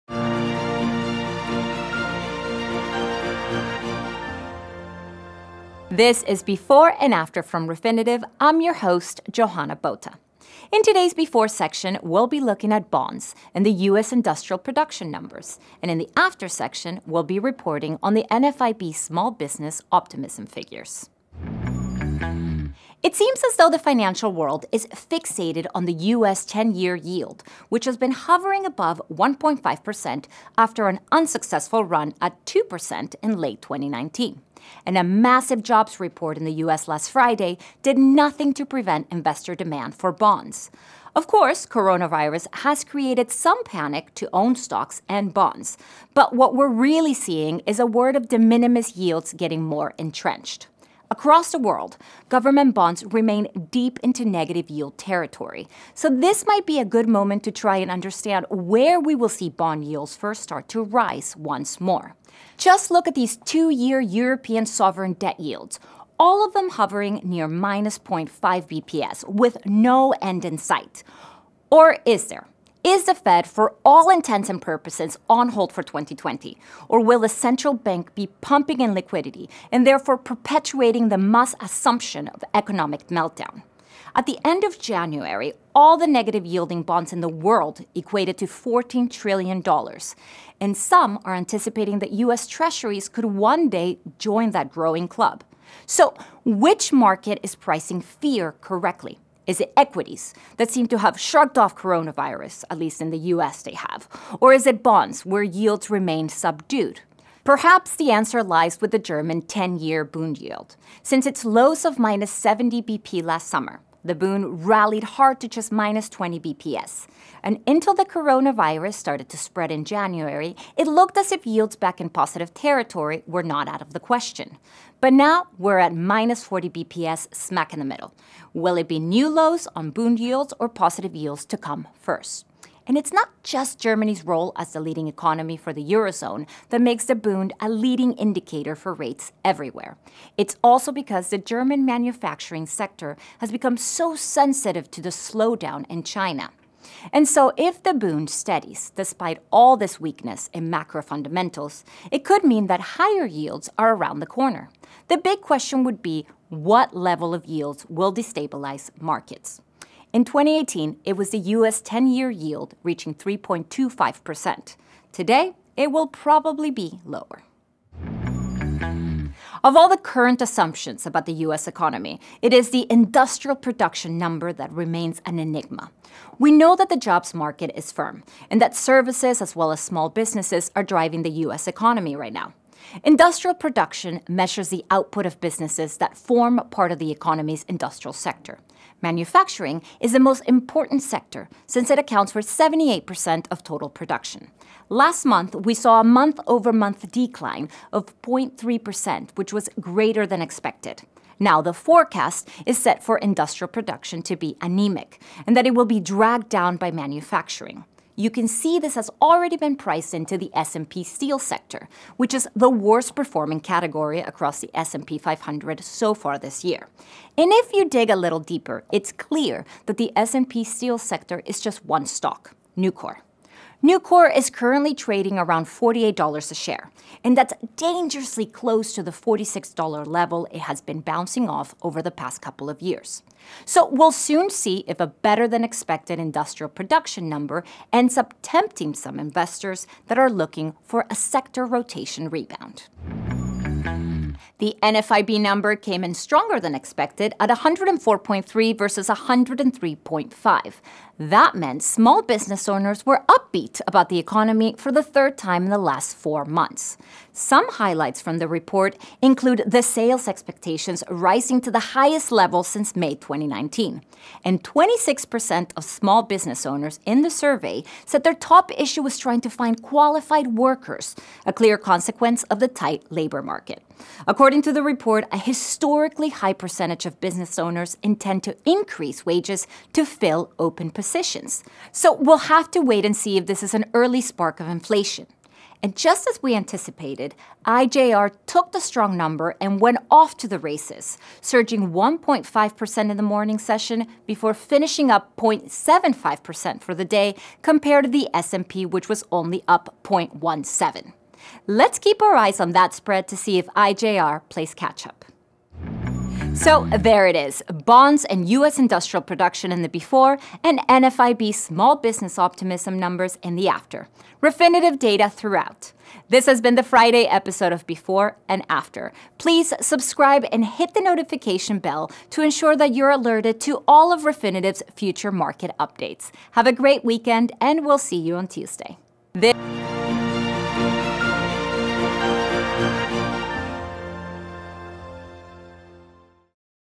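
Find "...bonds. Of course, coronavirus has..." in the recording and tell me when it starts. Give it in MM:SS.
00:40.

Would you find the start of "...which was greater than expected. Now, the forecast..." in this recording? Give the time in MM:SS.
03:19.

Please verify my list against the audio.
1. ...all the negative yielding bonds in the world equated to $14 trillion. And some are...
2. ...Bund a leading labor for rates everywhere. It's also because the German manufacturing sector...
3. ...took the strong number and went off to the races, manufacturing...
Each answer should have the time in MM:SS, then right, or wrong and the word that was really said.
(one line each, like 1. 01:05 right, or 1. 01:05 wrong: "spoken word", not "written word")
1. 01:25 right
2. 02:17 wrong: "indicator", not "labor"
3. 04:48 wrong: "surging", not "manufacturing".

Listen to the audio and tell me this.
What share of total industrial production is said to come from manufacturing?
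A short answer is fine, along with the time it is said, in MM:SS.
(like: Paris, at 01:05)
78%, at 03:12.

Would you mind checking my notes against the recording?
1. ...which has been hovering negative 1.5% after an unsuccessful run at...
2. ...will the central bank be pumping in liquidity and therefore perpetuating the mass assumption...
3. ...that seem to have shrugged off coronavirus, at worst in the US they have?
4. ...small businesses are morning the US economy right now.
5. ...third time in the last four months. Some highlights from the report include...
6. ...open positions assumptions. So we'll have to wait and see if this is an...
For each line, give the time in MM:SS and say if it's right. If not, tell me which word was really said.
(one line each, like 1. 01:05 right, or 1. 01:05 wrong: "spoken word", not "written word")
1. 00:27 wrong: "above", not "negative"
2. 01:17 right
3. 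01:40 wrong: "least", not "worst"
4. 02:59 wrong: "driving", not "morning"
5. 04:15 right
6. 04:40 wrong: "decisions", not "assumptions".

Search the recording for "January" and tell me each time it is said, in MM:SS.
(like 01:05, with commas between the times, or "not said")
01:24, 01:59.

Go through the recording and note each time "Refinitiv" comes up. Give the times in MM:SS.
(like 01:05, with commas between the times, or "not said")
00:07, 05:14, 05:24.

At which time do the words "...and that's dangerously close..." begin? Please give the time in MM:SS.
03:47.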